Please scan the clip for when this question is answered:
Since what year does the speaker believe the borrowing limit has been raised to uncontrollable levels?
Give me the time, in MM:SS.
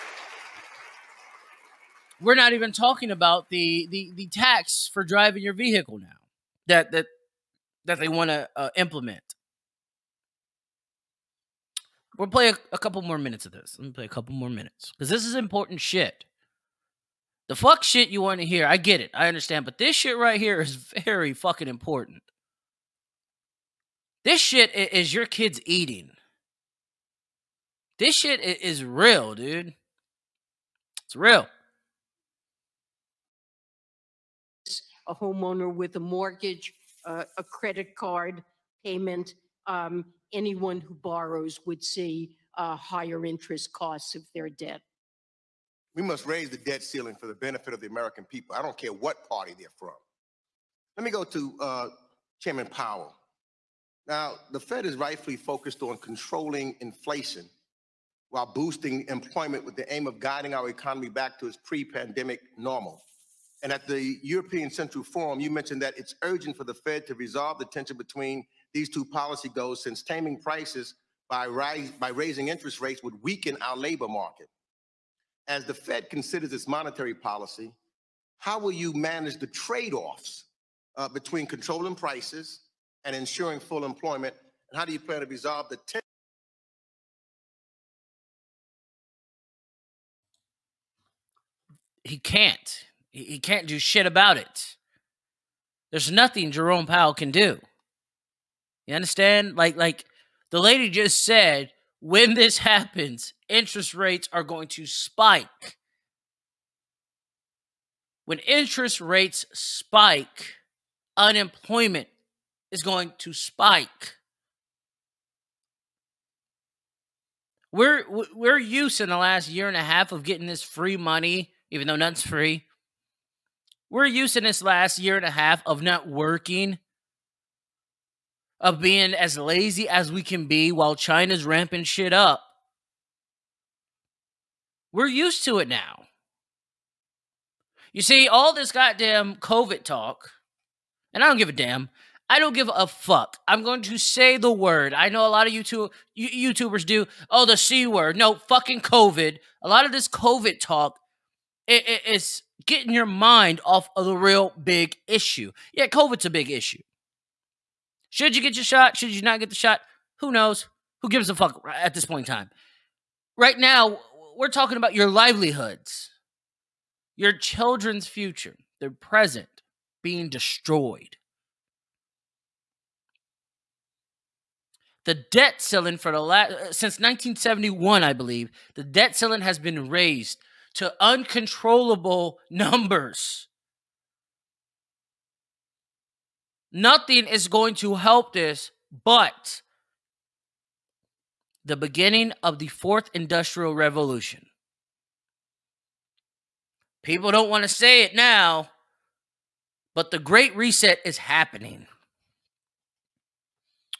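02:56.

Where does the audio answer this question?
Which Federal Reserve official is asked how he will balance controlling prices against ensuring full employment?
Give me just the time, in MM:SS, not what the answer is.
00:52.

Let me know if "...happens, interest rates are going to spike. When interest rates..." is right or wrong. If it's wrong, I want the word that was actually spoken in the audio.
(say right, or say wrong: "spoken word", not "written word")
right.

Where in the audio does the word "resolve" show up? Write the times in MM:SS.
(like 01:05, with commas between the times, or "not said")
01:07, 01:25.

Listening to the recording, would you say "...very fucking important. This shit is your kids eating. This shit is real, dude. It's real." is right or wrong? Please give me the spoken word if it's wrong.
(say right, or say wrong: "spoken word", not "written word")
right.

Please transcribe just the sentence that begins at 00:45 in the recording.
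We must raise the debt ceiling for the benefit of the American people.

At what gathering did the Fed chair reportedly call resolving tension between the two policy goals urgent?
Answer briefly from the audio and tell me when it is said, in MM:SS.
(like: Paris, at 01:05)
European Central Forum, at 01:04.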